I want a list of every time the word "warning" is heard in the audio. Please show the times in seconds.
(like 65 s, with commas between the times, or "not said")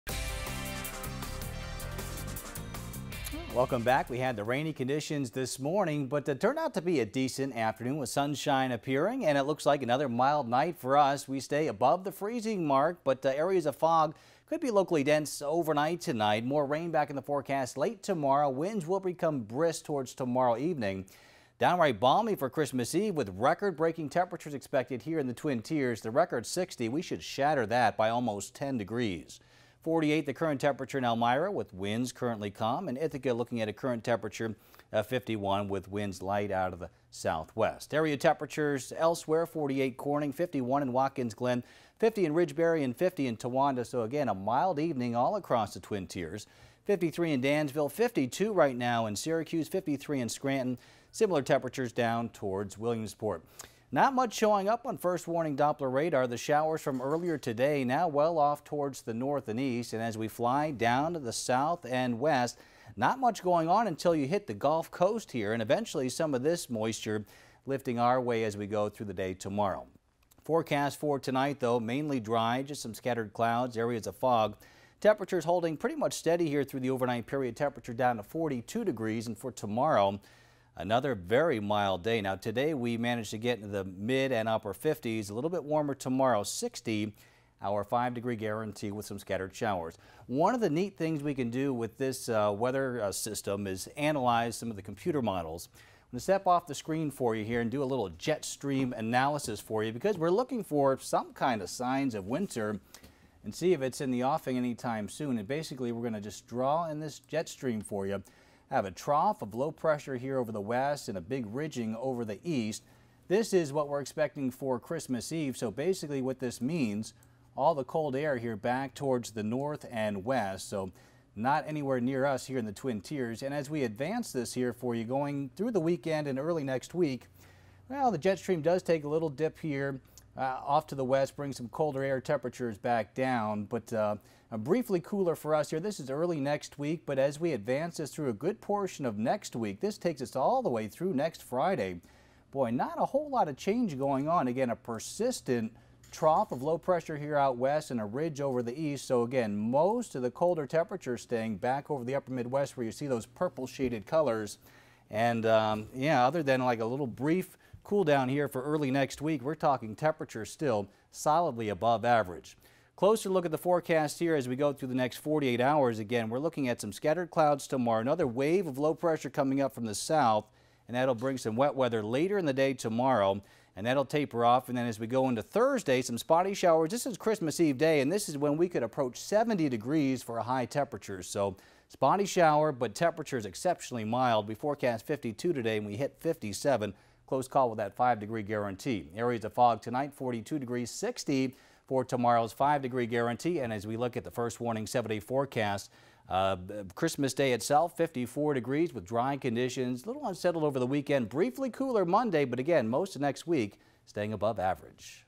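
55 s, 194 s.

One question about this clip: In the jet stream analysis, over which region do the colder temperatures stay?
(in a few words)
Upper Midwest.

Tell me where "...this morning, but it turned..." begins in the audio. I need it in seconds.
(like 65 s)
5 s.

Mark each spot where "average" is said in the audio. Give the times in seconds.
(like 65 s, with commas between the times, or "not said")
162 s, 204 s.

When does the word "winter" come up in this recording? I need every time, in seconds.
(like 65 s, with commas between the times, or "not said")
102 s.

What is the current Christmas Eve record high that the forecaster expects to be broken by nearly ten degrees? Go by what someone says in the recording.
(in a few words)
60.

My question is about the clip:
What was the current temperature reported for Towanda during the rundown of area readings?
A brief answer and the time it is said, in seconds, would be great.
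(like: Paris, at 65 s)
50, at 42 s.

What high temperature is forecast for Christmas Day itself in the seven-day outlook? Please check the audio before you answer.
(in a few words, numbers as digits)
54 degrees.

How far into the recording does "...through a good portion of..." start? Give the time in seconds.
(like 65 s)
138 s.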